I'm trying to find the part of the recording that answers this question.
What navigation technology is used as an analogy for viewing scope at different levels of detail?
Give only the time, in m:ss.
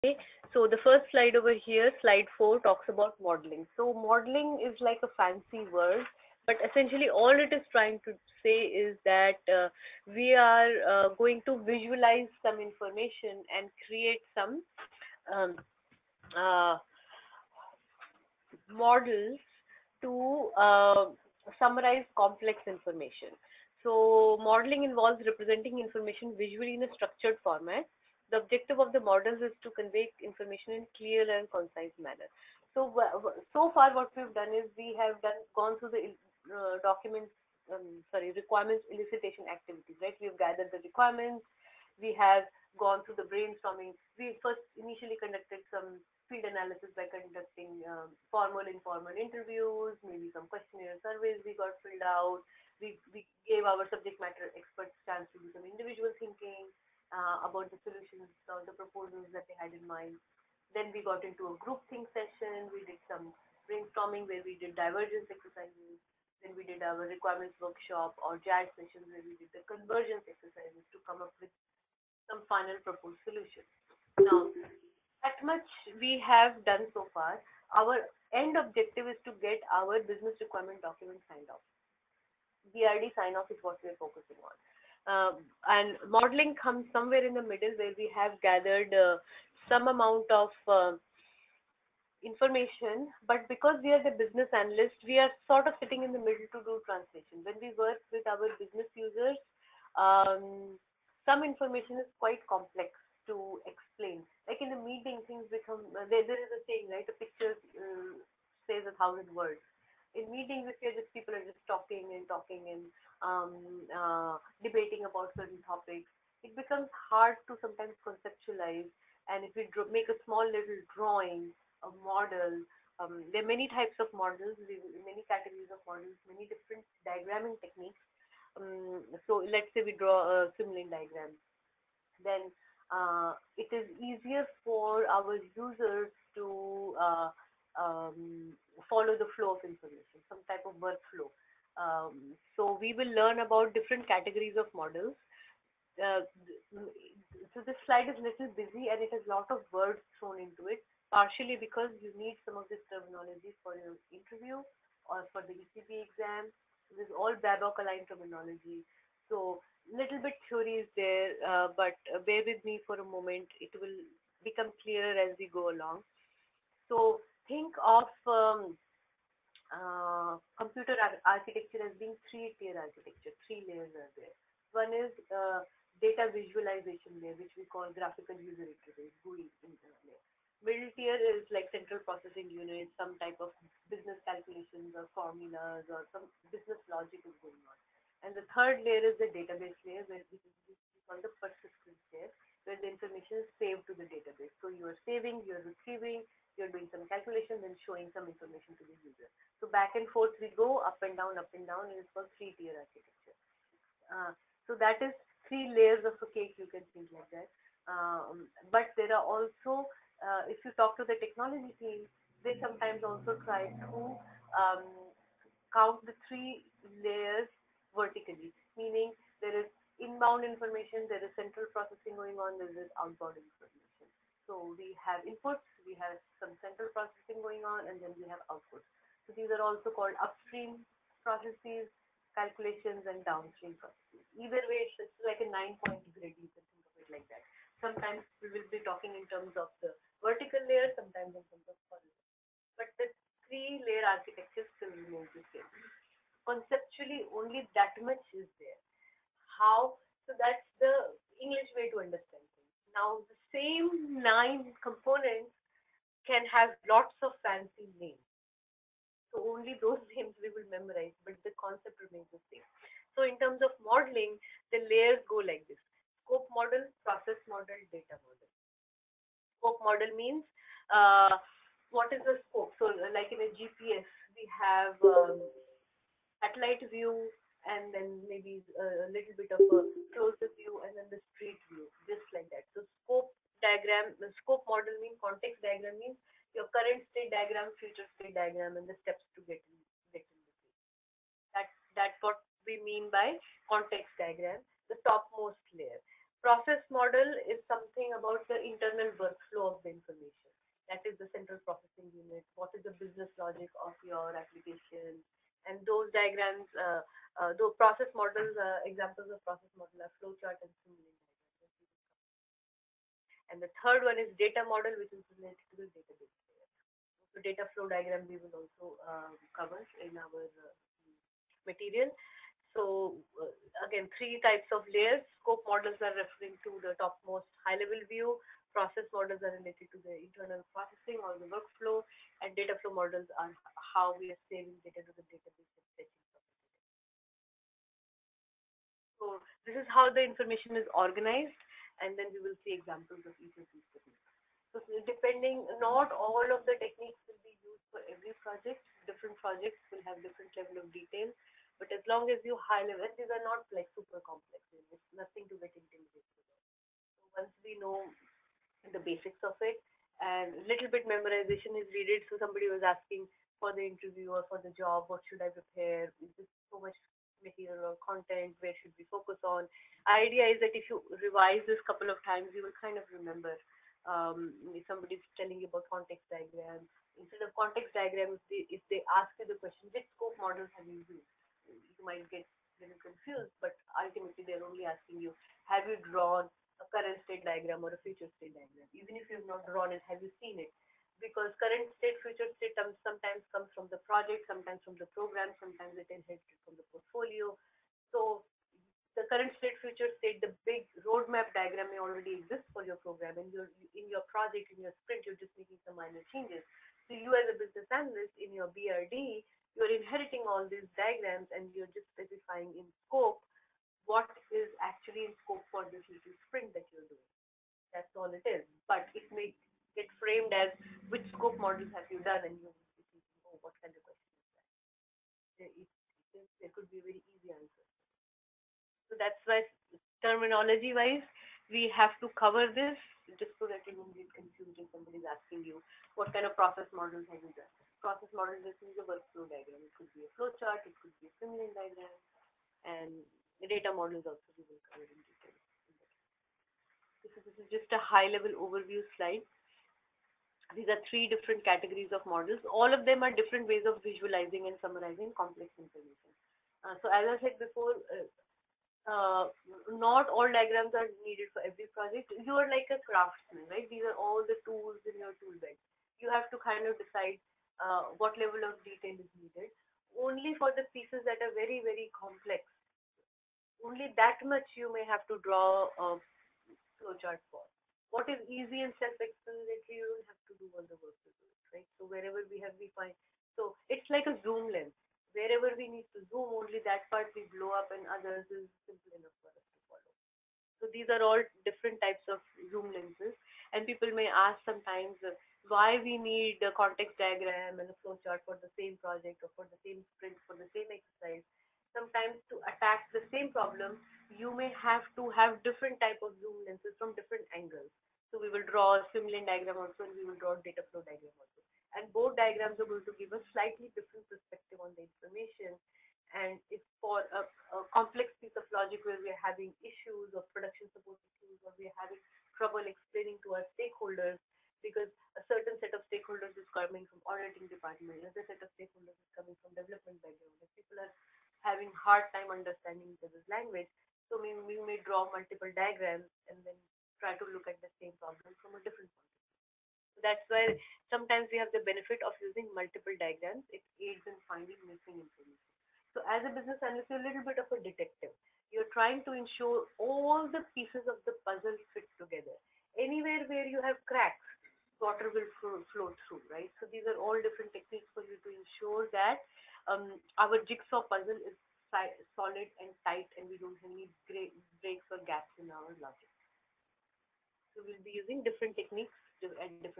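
4:33.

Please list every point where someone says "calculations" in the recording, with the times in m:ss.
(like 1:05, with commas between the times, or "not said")
3:04, 3:17, 3:52.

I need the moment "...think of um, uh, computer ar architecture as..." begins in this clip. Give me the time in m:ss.
2:47.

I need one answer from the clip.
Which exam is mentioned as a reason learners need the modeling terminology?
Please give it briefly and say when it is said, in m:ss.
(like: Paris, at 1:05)
ECBA exam, at 2:35.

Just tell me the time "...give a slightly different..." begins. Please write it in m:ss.
8:33.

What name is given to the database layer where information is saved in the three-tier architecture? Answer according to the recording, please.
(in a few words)
Persistence layer.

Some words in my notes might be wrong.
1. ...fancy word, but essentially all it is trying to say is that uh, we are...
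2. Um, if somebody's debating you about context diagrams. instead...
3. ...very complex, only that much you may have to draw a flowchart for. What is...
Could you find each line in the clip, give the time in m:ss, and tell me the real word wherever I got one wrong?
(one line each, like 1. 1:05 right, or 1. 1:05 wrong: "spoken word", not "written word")
1. 0:05 right
2. 6:14 wrong: "telling", not "debating"
3. 7:51 right.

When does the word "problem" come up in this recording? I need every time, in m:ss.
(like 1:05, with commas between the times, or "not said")
8:23, 8:58.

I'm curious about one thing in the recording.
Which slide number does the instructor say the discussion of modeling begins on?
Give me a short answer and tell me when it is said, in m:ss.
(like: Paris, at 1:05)
4, at 0:02.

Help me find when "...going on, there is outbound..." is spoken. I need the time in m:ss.
3:42.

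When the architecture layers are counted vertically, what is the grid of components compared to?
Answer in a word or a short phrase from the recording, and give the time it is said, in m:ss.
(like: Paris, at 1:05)
Nine-point grid, at 3:55.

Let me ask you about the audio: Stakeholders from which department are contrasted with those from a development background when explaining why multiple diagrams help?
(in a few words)
Auditing department.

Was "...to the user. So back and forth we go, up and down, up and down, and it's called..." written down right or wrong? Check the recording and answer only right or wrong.
right.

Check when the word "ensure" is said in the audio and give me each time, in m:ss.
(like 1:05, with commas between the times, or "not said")
9:09, 9:18.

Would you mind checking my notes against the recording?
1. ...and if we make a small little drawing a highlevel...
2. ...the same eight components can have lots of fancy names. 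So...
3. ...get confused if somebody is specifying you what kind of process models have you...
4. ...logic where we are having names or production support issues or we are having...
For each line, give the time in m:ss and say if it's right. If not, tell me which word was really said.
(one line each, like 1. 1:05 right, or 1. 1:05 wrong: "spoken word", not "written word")
1. 1:59 wrong: "model", not "highlevel"
2. 4:13 wrong: "nine", not "eight"
3. 7:14 wrong: "asking", not "specifying"
4. 8:38 wrong: "issues", not "names".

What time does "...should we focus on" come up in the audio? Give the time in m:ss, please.
6:08.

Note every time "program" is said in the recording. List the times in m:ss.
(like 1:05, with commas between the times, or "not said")
6:35, 6:43.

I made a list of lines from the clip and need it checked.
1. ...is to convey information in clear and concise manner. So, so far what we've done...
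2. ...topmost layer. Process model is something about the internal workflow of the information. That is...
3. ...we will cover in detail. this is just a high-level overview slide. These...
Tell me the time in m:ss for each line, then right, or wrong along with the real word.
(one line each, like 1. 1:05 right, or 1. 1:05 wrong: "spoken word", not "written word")
1. 0:29 right
2. 4:55 right
3. 7:24 right.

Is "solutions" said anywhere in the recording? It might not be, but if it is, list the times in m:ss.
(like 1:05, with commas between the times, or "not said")
0:57, 1:13.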